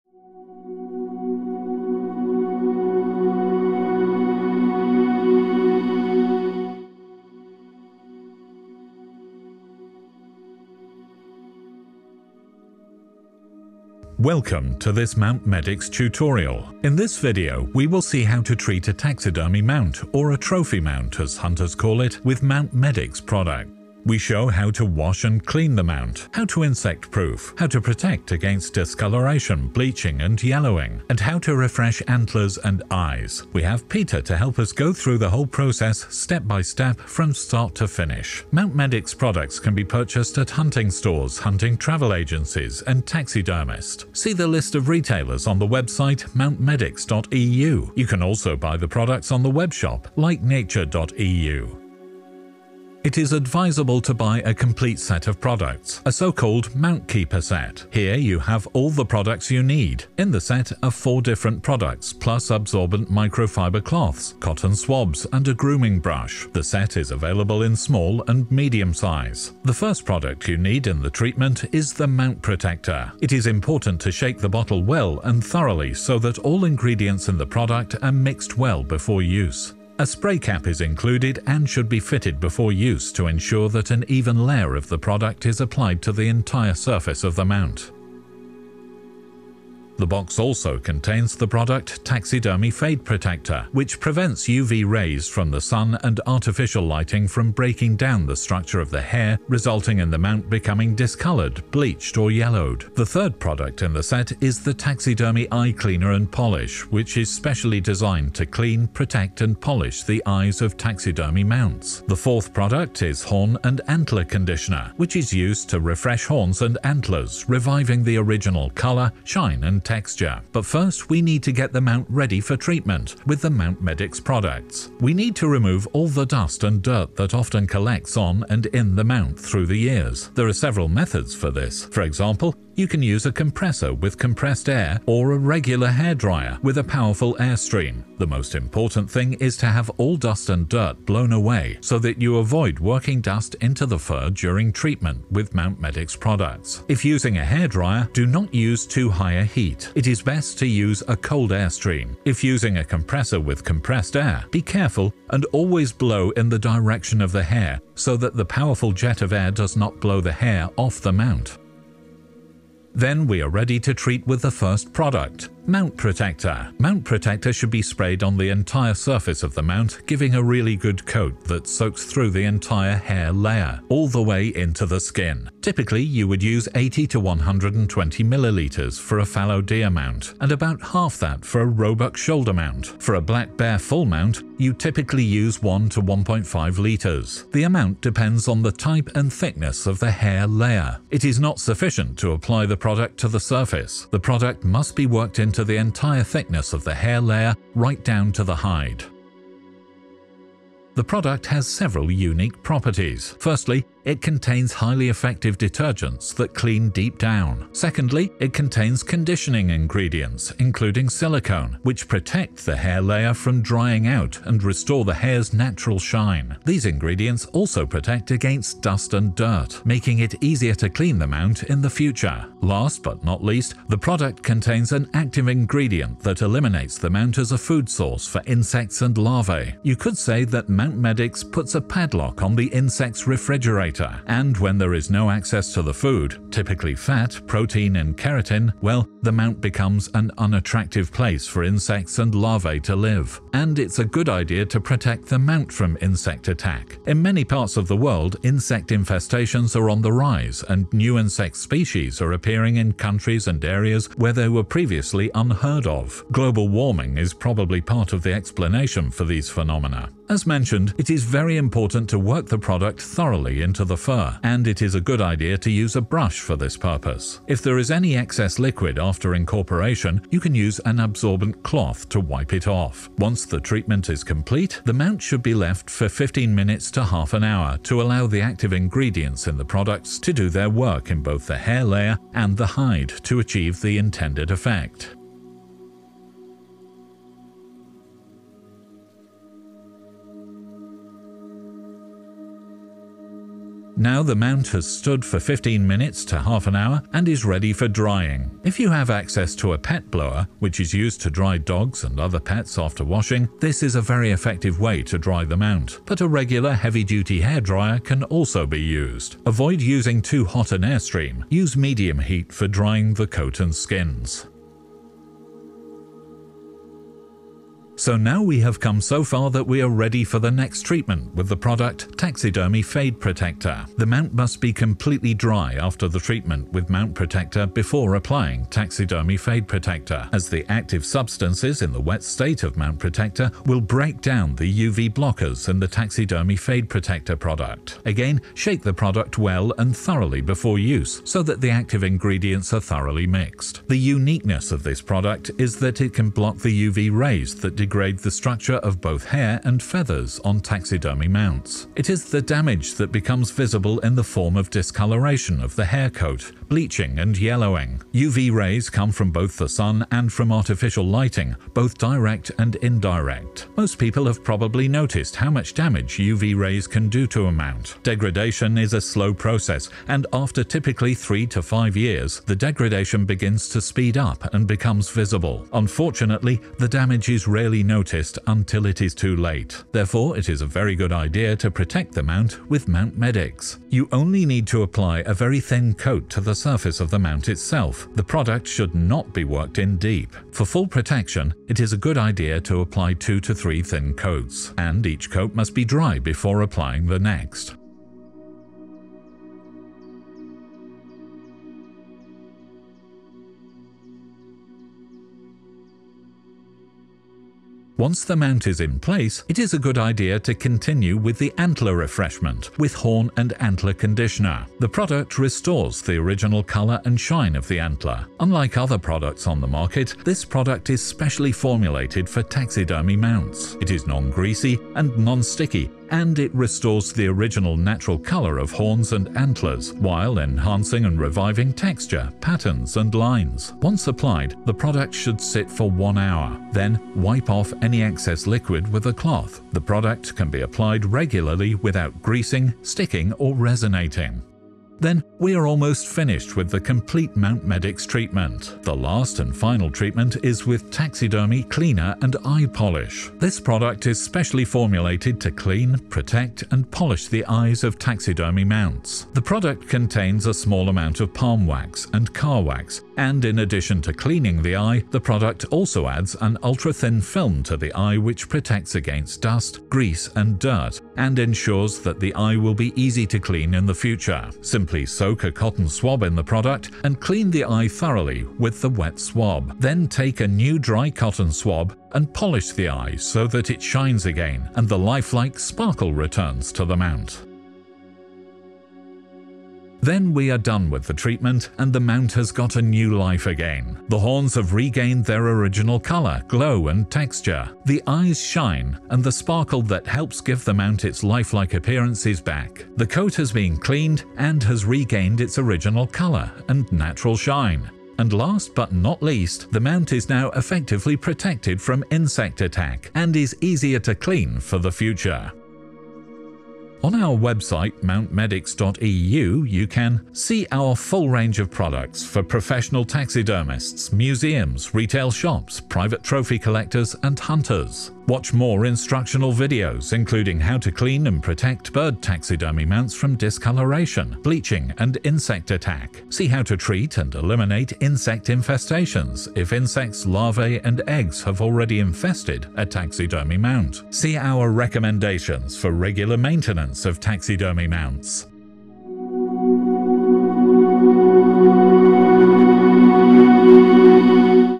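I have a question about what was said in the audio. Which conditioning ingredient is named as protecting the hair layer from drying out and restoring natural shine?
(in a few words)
silicone.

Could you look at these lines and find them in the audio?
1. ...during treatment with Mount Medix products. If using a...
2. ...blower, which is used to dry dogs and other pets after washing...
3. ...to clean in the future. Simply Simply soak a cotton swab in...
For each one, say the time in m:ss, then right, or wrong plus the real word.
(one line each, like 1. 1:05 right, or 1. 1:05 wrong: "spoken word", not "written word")
1. 2:24 right
2. 5:00 right
3. 7:53 right.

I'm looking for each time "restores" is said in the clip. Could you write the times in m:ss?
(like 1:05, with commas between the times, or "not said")
3:34, 6:55, 7:06.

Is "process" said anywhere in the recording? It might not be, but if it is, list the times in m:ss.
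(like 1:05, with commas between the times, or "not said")
0:35, 6:09.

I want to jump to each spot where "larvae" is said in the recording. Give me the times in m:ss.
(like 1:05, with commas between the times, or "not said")
3:49, 4:02, 9:00.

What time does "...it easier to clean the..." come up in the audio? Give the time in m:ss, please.
3:40.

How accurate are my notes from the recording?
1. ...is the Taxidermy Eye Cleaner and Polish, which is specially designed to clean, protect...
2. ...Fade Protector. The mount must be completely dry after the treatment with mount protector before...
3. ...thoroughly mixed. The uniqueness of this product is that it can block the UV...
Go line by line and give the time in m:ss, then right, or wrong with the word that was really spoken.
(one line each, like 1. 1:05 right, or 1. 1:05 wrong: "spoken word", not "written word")
1. 1:44 right
2. 5:22 right
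3. 5:42 right.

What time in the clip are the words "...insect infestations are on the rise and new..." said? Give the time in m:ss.
4:08.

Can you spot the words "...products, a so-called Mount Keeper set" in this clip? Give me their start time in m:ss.
0:55.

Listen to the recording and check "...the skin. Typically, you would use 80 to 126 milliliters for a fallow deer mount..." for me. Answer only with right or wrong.
wrong.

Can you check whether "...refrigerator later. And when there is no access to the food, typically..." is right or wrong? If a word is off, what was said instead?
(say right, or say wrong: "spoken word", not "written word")
right.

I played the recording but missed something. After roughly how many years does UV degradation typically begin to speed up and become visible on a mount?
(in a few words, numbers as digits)
3 to 5 years.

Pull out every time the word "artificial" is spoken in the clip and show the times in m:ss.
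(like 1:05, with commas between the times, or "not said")
1:36, 6:00.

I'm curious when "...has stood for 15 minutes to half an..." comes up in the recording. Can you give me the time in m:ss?
4:54.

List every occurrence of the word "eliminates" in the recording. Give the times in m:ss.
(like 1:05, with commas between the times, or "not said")
3:46, 8:57.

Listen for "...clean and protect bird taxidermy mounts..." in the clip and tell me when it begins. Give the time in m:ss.
8:50.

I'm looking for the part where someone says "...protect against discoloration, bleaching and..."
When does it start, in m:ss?
0:27.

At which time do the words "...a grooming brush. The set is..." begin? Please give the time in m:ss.
1:05.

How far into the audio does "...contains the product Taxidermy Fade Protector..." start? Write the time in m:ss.
1:30.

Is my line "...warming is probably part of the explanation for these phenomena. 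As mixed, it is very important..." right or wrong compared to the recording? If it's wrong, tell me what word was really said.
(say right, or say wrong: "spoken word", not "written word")
wrong: "mentioned", not "mixed".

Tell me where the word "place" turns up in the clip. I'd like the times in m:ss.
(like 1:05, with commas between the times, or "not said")
4:01, 6:48.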